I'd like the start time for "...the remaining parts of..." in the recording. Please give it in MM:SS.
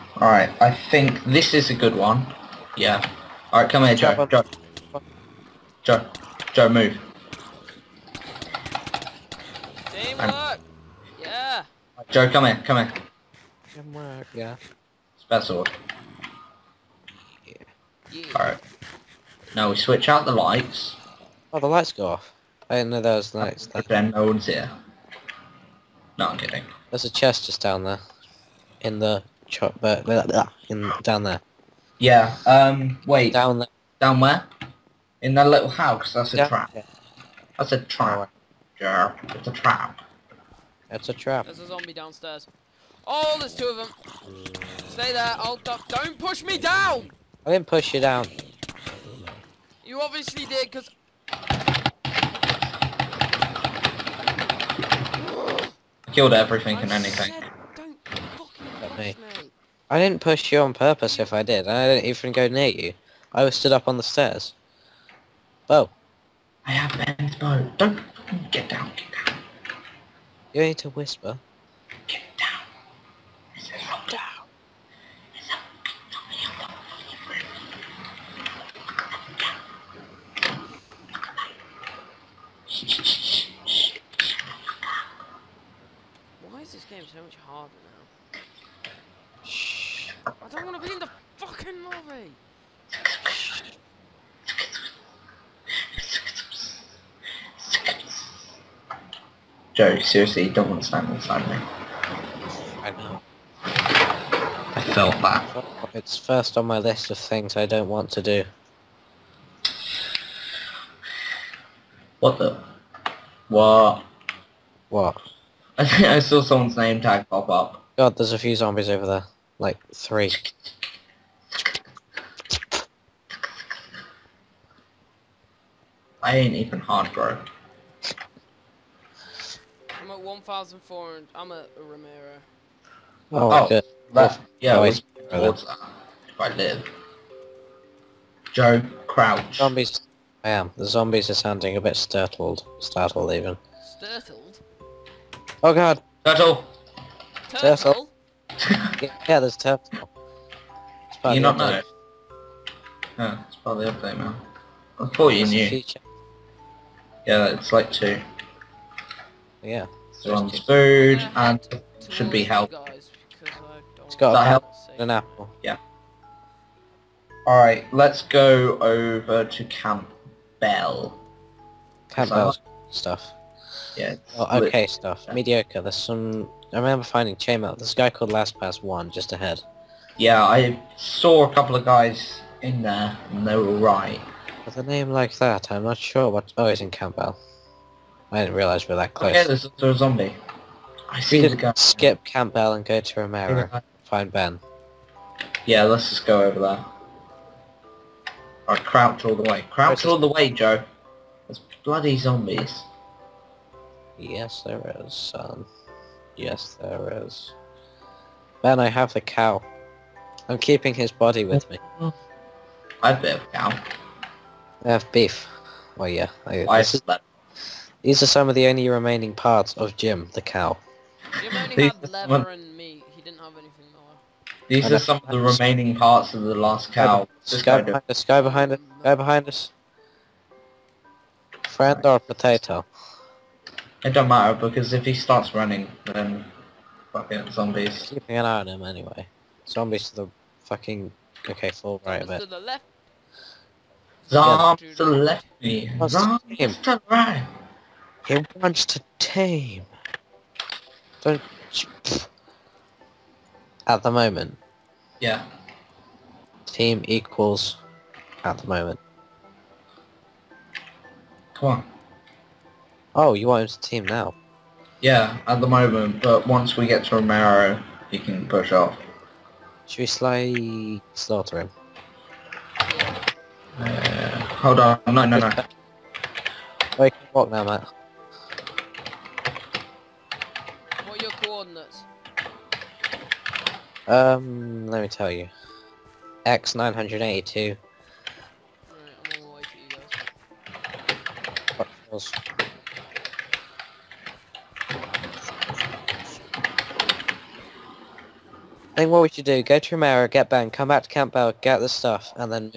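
03:45.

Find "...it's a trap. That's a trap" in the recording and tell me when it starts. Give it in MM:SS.
00:39.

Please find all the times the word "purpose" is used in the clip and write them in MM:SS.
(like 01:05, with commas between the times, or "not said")
01:00.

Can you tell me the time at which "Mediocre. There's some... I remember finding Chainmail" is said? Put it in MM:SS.
02:55.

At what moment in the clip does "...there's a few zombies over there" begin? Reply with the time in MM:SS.
01:58.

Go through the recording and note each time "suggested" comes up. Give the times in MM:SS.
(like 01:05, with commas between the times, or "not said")
not said.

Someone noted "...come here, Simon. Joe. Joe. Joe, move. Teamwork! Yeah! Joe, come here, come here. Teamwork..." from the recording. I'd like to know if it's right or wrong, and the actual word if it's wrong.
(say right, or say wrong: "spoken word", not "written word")
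wrong: "Joe", not "Simon".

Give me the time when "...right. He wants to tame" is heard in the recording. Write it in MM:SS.
04:07.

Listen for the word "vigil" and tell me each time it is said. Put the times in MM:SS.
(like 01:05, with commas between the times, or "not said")
not said.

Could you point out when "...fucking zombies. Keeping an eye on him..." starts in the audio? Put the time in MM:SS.
03:57.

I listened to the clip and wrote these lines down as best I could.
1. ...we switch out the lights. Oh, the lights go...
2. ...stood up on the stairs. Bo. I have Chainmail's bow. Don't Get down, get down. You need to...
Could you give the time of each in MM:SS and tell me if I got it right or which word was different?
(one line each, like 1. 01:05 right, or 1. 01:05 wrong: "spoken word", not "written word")
1. 00:19 right
2. 01:03 wrong: "Ben", not "Chainmail".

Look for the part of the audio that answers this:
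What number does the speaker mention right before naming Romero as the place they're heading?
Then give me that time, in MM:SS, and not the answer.
02:10.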